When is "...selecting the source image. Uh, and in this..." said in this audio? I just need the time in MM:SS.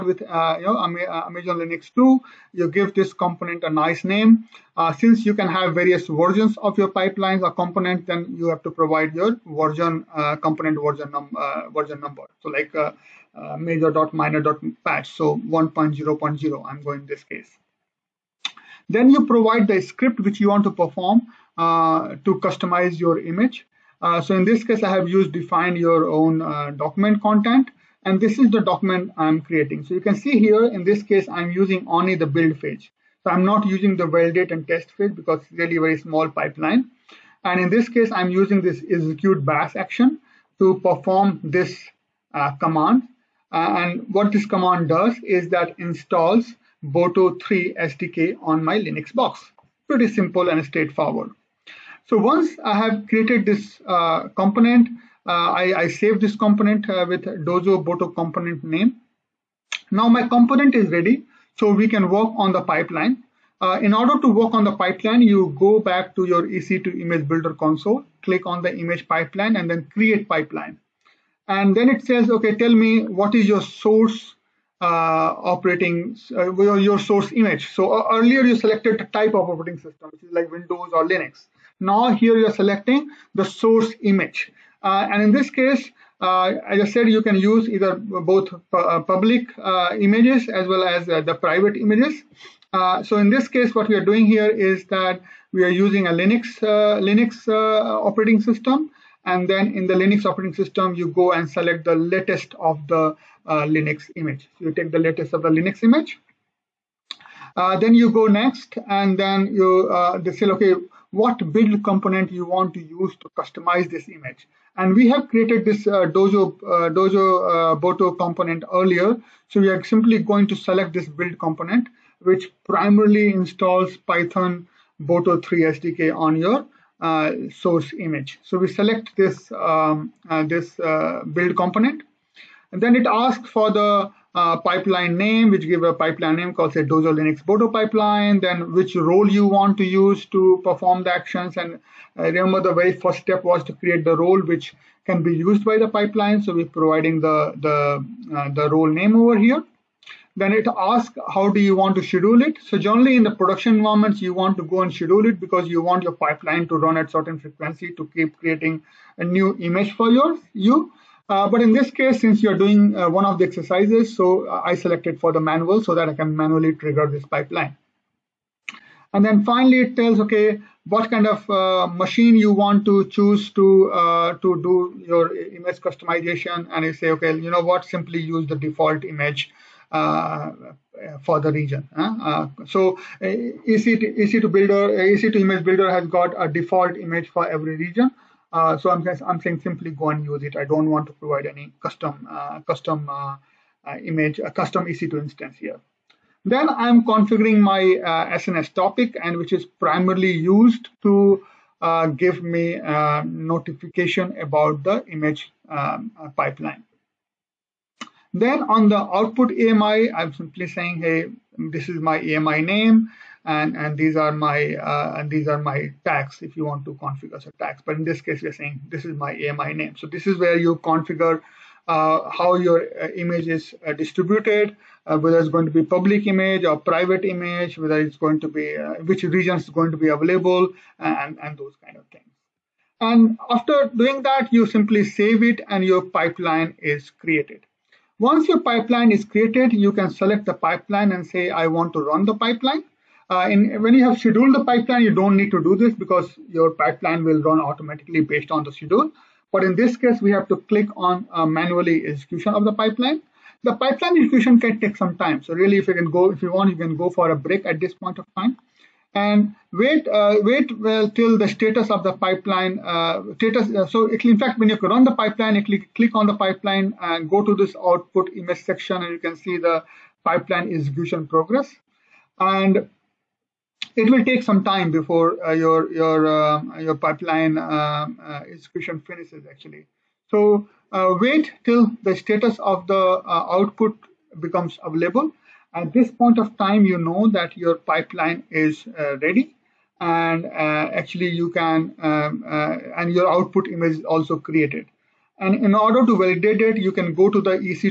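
01:22.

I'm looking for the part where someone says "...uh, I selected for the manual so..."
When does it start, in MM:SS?
02:44.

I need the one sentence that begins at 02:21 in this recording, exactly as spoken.
And remember the very first step was to create the role which can be used by the pipeline.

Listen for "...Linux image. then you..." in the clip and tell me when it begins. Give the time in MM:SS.
01:45.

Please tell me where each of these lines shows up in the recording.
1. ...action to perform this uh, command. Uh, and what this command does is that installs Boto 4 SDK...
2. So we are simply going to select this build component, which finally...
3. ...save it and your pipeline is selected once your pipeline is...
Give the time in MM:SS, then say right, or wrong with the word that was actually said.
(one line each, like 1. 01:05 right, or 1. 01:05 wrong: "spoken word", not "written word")
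1. 00:39 wrong: "3", not "4"
2. 01:59 wrong: "primarily", not "finally"
3. 03:55 wrong: "created", not "selected".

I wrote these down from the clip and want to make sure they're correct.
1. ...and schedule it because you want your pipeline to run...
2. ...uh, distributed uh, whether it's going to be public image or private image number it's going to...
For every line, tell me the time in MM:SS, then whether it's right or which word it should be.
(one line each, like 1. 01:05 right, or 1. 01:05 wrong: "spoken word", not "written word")
1. 02:34 right
2. 03:43 wrong: "whether", not "number".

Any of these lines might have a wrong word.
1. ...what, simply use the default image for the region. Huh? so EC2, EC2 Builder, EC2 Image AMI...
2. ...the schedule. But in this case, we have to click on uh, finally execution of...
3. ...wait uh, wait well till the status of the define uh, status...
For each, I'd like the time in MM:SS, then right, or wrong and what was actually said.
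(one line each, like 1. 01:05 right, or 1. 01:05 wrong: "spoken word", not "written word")
1. 02:57 wrong: "Builder", not "AMI"
2. 04:08 wrong: "manually", not "finally"
3. 04:19 wrong: "pipeline", not "define".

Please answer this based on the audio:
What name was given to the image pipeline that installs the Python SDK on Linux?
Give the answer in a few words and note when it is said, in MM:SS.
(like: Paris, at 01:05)
Dojo Linux Boto pipeline, at 02:16.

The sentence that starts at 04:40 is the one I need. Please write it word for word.
So uh, wait till the status of the uh, output becomes available.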